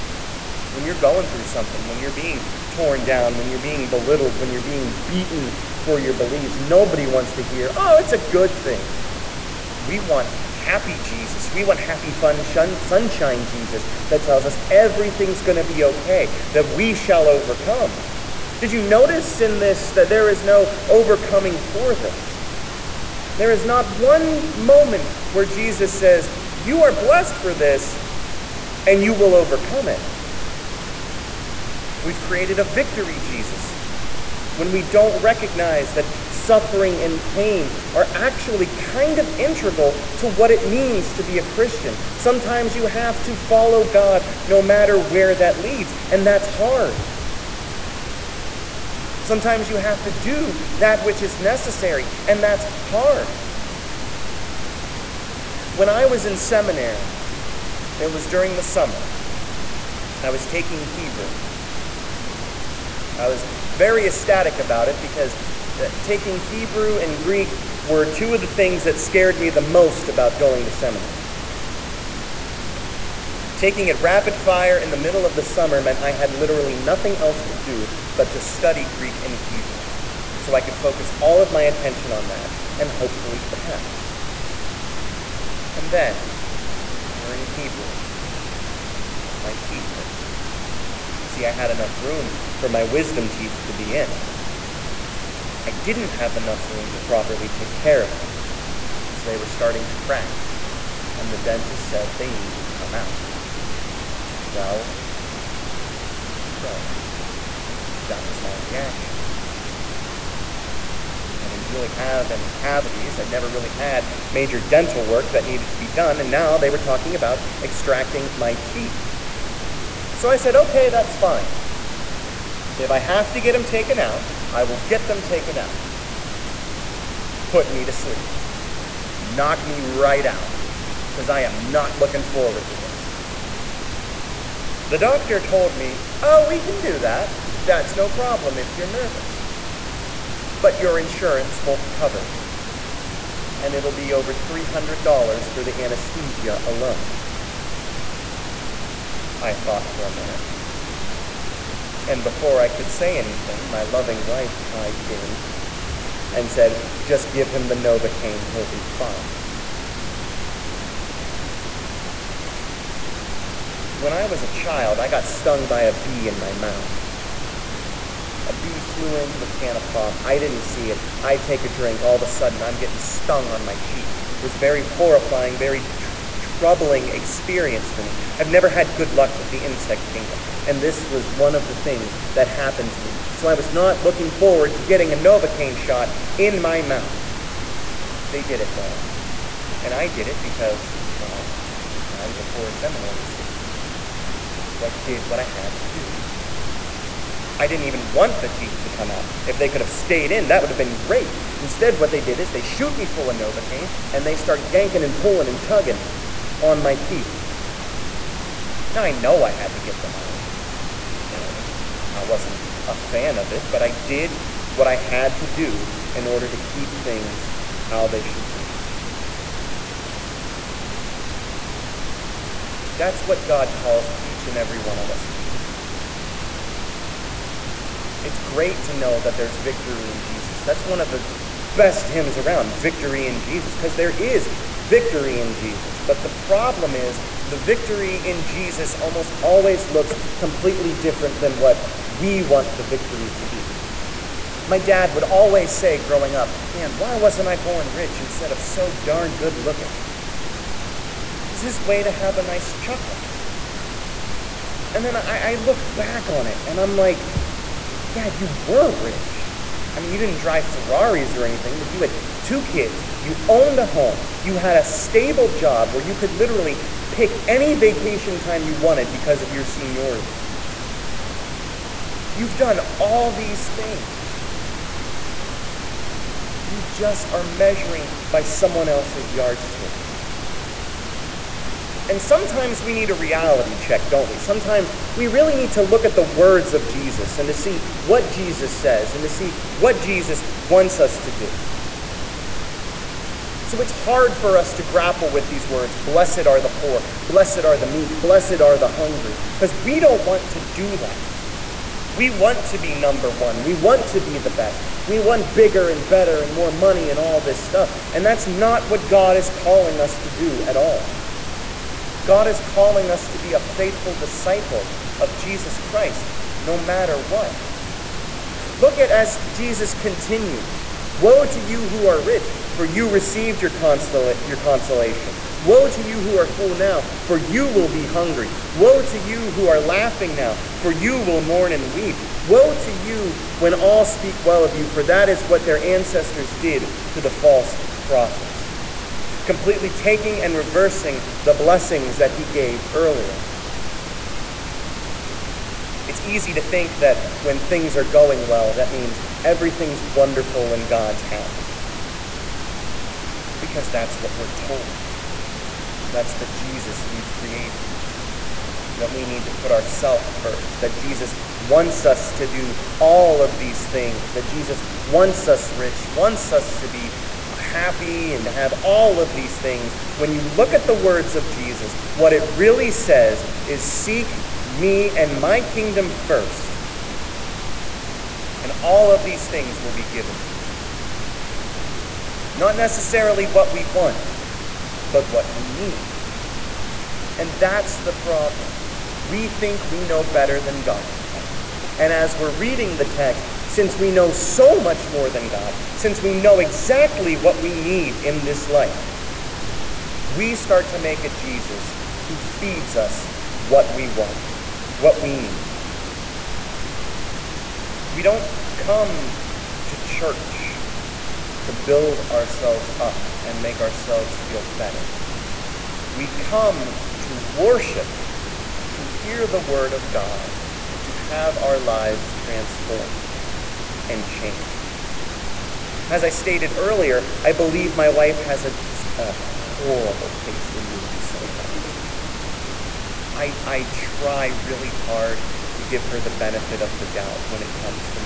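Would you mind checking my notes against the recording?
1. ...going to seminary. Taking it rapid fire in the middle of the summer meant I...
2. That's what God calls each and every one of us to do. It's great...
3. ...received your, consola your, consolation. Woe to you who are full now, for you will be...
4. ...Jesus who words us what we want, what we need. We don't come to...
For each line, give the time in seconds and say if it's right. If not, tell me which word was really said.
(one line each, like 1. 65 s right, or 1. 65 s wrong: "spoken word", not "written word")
1. 70 s right
2. 222 s right
3. 323 s right
4. 401 s wrong: "feeds", not "words".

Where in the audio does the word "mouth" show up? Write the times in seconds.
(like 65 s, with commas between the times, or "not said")
166 s, 186 s.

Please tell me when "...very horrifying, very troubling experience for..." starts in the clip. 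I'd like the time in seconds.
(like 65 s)
174 s.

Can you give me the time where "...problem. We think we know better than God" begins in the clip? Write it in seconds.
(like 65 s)
388 s.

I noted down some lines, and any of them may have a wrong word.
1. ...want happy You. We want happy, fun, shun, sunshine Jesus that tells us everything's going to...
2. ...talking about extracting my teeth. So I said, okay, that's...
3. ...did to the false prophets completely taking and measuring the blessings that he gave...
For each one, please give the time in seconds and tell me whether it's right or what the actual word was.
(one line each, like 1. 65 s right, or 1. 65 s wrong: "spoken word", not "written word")
1. 9 s wrong: "Jesus", not "You"
2. 116 s right
3. 336 s wrong: "reversing", not "measuring".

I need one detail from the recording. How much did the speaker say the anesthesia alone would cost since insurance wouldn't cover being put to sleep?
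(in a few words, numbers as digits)
Over $300.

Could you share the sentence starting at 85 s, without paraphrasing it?
And then, during Hebrew, my teeth hurt.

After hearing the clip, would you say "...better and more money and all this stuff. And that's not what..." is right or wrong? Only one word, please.
right.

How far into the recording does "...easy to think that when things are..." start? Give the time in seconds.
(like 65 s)
346 s.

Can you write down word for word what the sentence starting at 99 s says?
So they were starting to crack, and the dentist said they need to come out.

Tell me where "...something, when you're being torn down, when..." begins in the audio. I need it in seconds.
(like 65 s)
1 s.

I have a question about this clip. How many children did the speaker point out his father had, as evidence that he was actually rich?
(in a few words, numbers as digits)
2.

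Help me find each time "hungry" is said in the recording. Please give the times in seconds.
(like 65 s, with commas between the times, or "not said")
298 s, 328 s.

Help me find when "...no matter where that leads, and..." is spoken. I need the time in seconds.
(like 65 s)
44 s.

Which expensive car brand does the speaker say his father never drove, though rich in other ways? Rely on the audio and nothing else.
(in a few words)
Ferraris.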